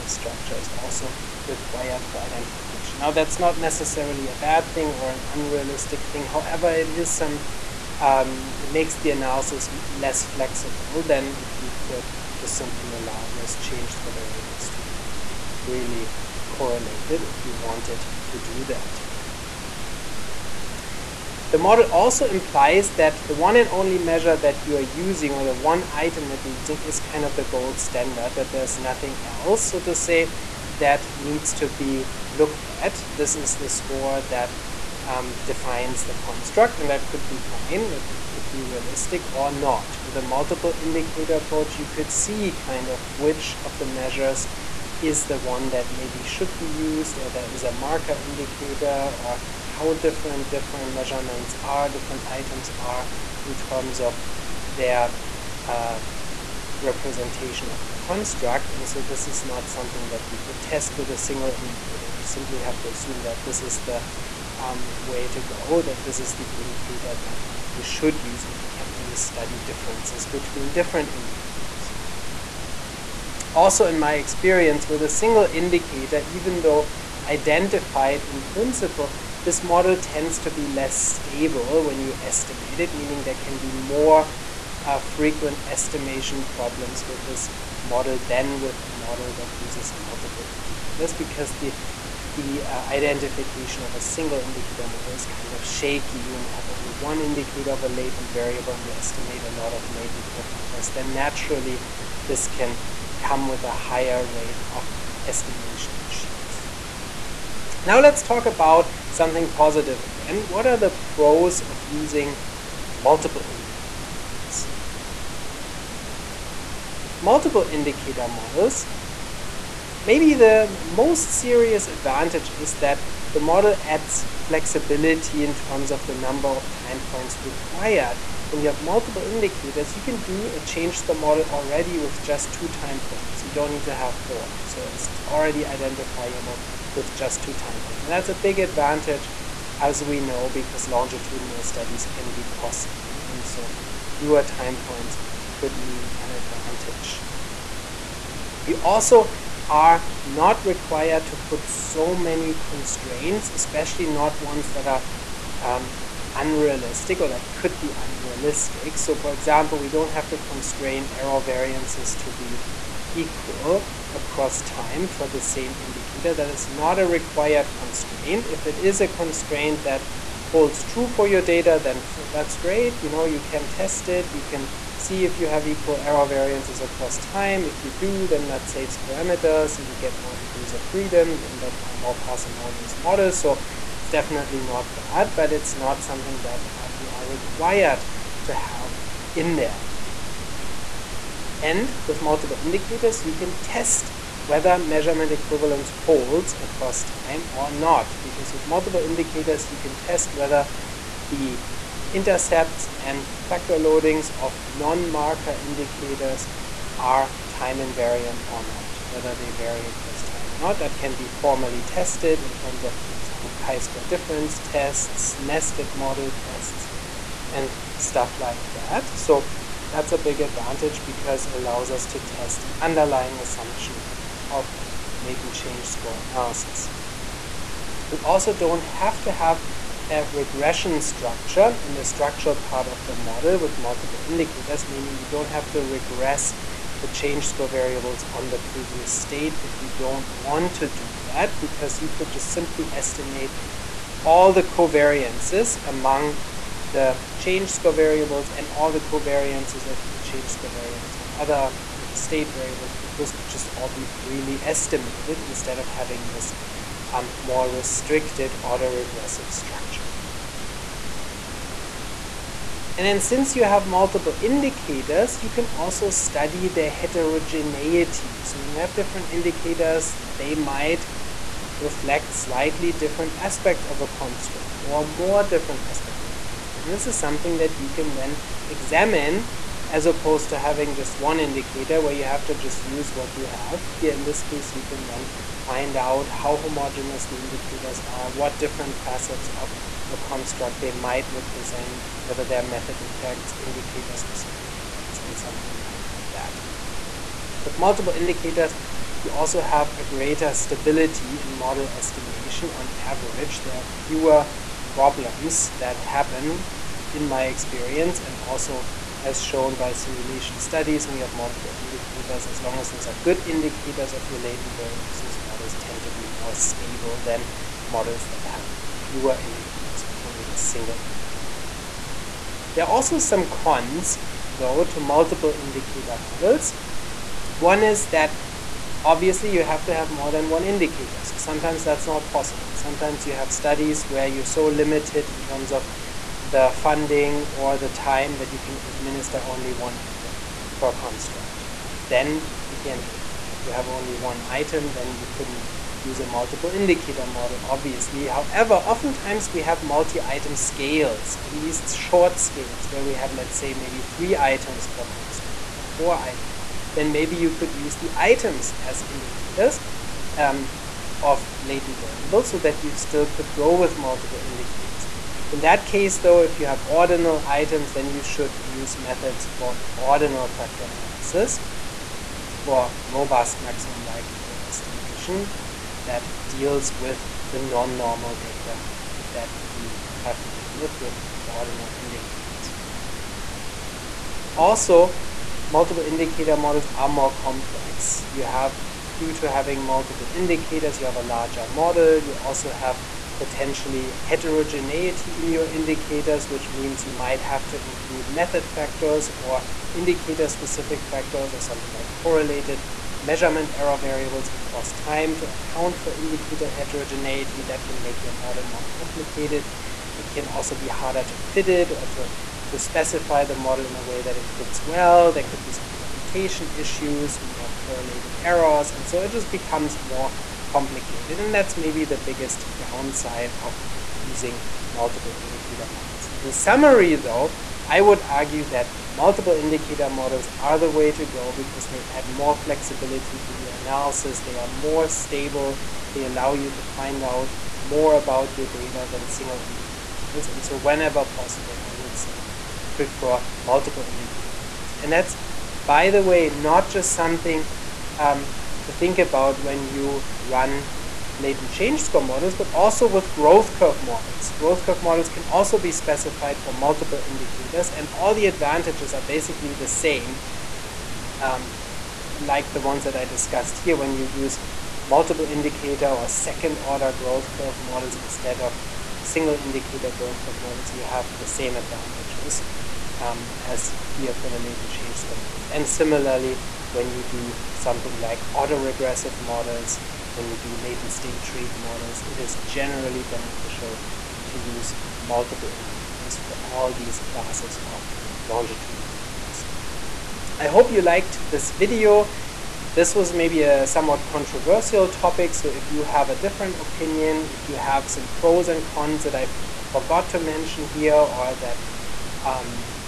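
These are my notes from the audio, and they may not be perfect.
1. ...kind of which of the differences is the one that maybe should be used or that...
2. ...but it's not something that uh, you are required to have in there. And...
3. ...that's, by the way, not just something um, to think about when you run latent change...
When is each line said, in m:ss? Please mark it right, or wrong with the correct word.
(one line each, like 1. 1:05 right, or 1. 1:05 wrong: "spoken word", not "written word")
1. 0:42 wrong: "measures", not "differences"
2. 3:05 right
3. 7:25 right.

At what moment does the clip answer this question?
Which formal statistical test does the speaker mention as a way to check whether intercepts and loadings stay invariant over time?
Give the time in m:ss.
3:33.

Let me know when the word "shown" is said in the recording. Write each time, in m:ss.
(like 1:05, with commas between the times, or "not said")
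5:09.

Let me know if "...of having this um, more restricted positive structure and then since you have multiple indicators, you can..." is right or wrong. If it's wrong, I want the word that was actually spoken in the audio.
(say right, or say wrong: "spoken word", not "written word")
wrong: "autoregressive", not "positive".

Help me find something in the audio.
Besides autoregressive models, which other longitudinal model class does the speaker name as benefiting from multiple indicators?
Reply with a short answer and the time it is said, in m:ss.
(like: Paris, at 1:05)
latent state trait models, at 8:00.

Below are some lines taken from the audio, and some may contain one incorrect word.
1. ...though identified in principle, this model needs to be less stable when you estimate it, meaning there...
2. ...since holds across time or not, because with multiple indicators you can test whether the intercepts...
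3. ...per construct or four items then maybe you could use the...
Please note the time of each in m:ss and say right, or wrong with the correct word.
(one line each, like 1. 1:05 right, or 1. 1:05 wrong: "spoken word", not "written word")
1. 1:16 wrong: "tends", not "needs"
2. 3:15 wrong: "equivalence", not "since"
3. 5:54 right.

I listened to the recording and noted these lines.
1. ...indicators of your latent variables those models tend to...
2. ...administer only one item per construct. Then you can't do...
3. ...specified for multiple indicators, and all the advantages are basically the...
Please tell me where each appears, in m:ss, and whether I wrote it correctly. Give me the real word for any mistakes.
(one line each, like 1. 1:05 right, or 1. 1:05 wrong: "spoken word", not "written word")
1. 5:13 right
2. 5:38 right
3. 7:35 right.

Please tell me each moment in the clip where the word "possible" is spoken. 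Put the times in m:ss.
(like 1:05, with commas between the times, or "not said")
5:32, 7:21.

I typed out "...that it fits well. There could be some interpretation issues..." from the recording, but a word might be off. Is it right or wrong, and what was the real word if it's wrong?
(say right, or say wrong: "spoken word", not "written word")
right.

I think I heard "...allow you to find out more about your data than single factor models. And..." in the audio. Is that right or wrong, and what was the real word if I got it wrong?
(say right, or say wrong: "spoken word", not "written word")
wrong: "indicator", not "factor".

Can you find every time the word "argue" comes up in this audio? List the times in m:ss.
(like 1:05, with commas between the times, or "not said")
7:08.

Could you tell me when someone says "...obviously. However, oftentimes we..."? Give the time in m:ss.
5:47.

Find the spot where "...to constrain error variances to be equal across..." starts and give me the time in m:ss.
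2:40.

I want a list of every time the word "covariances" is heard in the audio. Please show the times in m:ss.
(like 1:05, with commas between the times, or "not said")
4:04, 4:09.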